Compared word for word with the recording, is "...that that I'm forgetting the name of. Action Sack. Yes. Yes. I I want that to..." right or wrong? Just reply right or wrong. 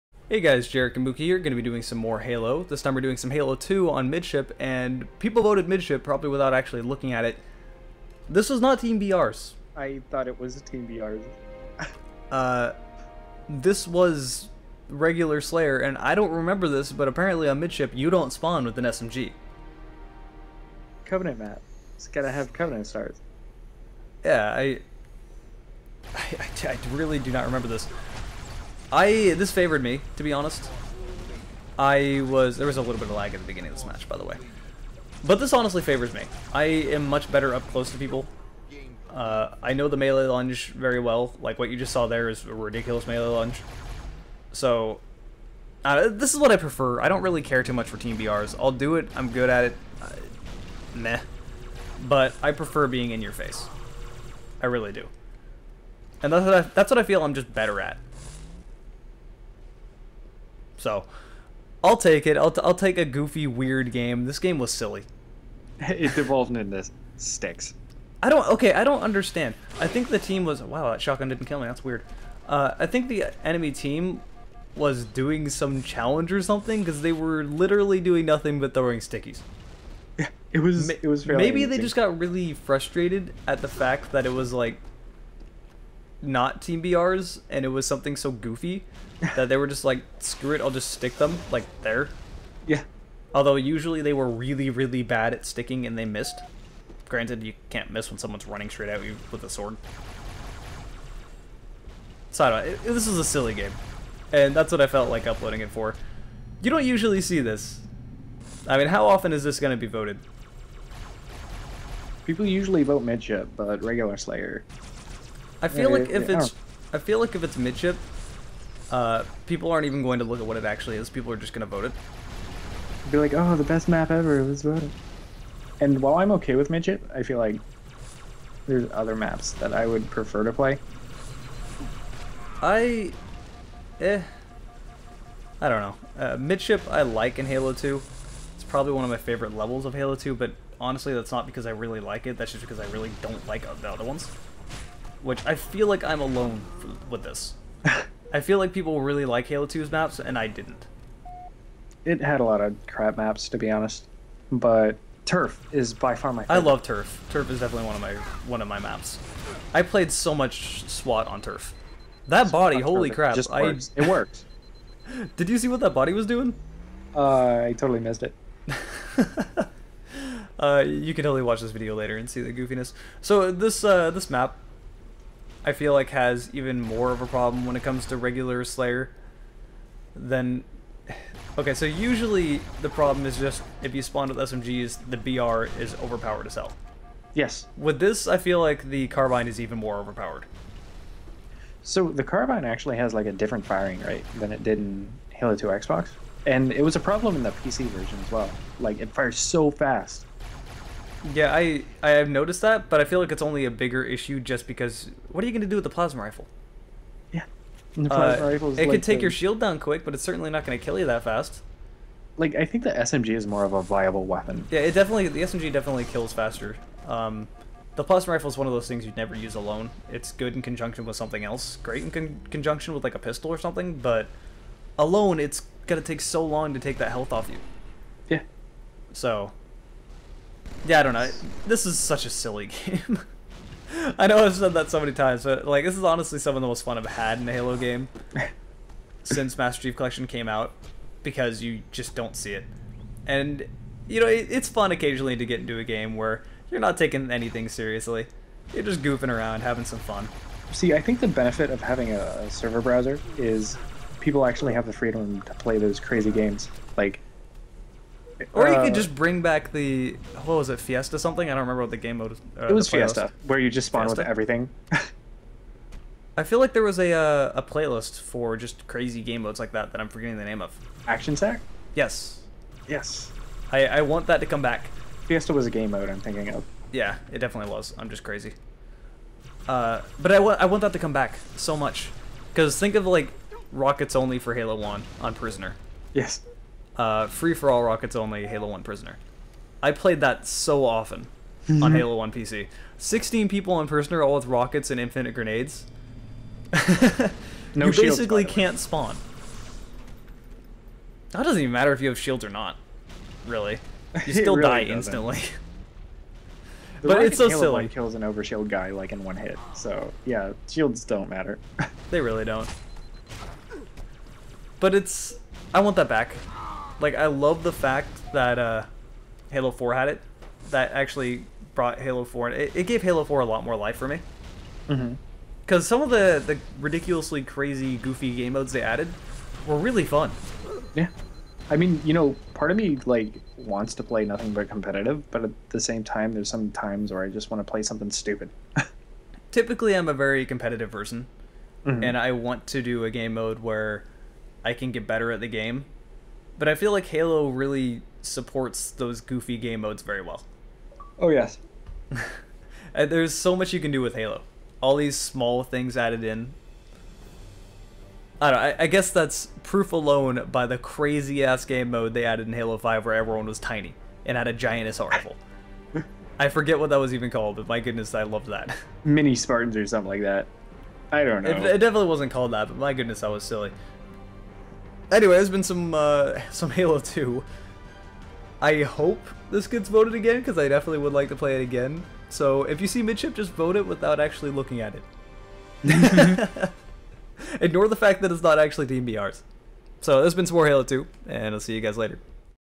right.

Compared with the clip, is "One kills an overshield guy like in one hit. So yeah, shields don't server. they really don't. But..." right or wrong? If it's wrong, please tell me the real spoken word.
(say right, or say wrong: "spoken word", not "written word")
wrong: "matter", not "server".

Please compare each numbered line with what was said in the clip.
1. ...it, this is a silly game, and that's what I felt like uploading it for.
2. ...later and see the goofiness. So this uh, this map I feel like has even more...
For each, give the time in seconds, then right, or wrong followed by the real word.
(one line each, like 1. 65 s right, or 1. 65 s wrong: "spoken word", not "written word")
1. 102 s right
2. 171 s right.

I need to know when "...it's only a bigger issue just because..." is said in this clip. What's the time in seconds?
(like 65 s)
203 s.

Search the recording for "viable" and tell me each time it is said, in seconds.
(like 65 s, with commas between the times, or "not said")
213 s.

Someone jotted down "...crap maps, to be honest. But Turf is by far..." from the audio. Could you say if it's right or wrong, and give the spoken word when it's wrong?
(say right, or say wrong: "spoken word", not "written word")
right.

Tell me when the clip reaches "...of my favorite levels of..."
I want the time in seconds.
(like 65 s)
139 s.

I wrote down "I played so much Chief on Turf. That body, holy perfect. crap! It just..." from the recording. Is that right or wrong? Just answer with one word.
wrong.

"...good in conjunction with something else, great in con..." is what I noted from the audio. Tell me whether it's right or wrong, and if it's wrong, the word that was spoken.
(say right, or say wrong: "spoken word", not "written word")
right.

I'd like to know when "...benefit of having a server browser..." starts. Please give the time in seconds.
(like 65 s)
251 s.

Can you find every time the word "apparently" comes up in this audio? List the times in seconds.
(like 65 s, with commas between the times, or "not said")
17 s.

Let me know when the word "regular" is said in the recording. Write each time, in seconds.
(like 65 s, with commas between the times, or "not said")
14 s, 113 s, 178 s.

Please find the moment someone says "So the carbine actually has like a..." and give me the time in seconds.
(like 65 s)
191 s.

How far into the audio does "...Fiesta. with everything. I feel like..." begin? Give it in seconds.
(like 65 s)
264 s.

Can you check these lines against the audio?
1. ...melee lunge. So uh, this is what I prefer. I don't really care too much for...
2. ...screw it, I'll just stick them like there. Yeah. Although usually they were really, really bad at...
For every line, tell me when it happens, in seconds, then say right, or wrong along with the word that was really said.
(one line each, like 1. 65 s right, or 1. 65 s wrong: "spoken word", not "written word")
1. 43 s right
2. 90 s right.